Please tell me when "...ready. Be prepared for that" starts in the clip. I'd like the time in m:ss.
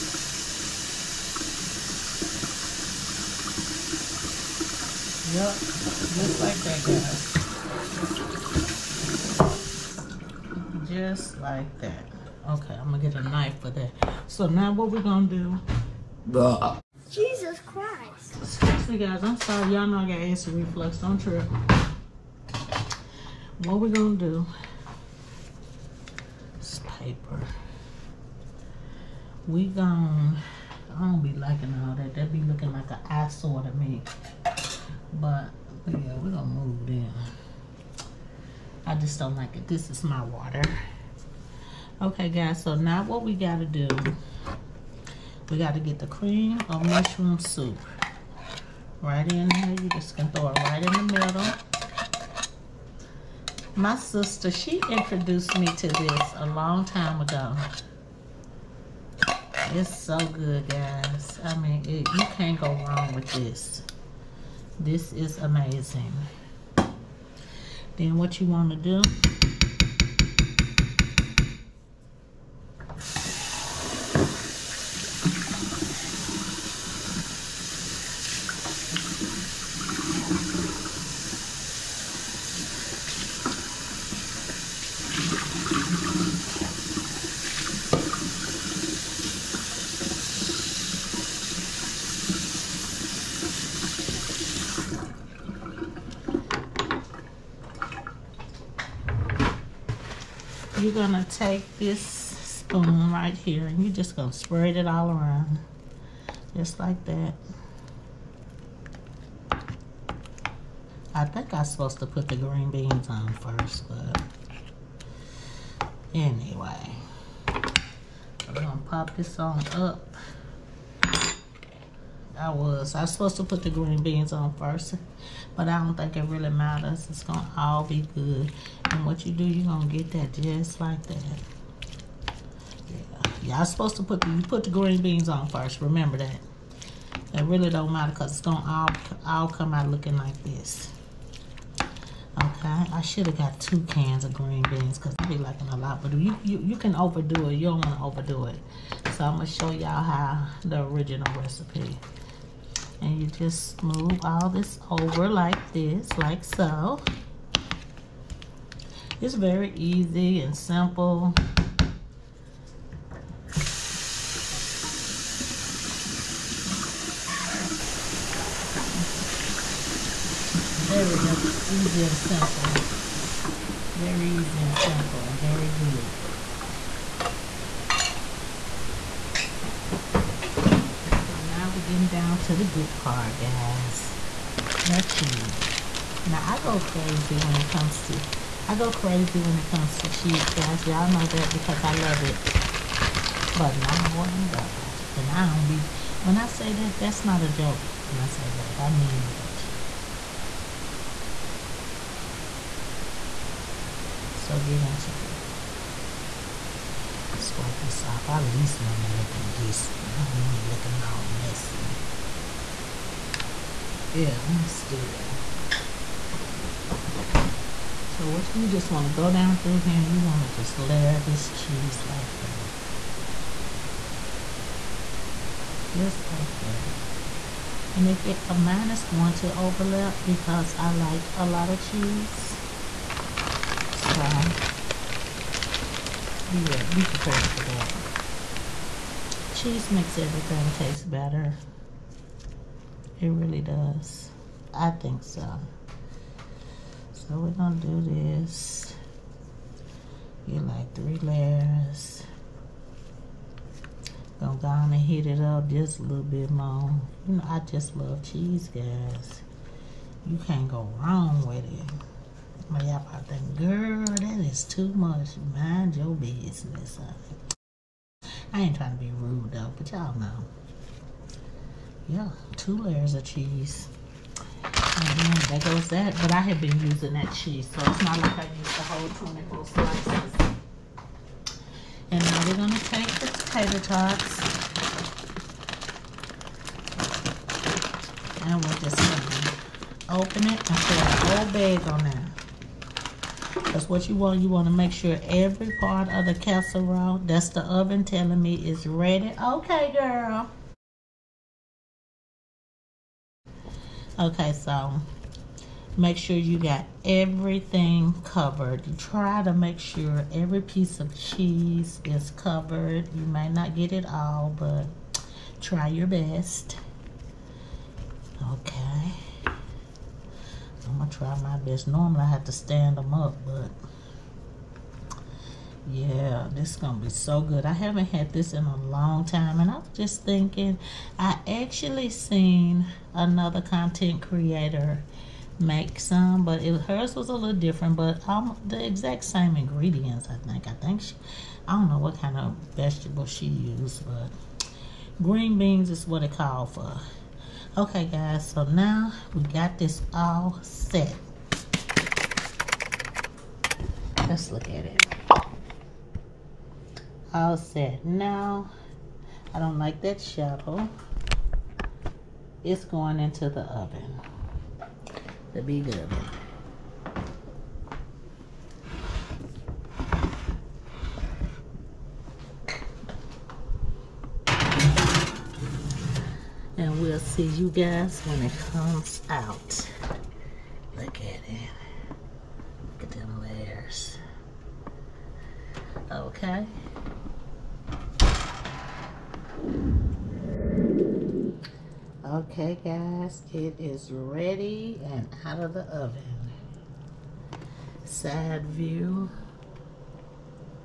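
3:56.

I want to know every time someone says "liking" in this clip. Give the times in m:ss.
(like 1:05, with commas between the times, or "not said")
0:31, 2:25.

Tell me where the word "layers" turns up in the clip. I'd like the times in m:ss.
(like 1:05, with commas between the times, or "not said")
3:40, 4:11, 4:32, 6:23.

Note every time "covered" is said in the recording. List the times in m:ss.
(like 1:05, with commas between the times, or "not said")
5:08, 5:12.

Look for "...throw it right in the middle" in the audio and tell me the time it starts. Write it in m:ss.
0:50.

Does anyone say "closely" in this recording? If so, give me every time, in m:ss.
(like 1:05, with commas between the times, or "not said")
not said.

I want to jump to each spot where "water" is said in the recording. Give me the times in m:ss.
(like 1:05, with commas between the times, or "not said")
0:40.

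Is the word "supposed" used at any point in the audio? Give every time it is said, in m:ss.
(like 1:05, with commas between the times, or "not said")
1:51, 2:03, 2:13.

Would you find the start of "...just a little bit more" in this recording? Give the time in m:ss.
4:15.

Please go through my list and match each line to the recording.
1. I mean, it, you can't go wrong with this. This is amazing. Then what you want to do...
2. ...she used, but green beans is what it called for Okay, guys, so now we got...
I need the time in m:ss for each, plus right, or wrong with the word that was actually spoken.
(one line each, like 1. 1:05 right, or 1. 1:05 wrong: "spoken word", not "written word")
1. 1:01 right
2. 5:43 right.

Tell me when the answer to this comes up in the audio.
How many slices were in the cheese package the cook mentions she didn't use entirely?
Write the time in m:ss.
4:39.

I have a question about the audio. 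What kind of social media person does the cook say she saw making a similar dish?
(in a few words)
Content creator.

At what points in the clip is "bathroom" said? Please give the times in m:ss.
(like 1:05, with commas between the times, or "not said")
not said.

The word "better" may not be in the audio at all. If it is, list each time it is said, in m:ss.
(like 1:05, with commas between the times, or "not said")
4:01.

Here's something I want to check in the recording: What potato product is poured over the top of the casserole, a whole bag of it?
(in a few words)
Potato tots.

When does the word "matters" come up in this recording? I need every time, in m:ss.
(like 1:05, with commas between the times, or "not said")
2:06, 2:17.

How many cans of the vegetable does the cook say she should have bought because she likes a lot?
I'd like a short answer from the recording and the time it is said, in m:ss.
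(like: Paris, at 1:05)
2, at 2:23.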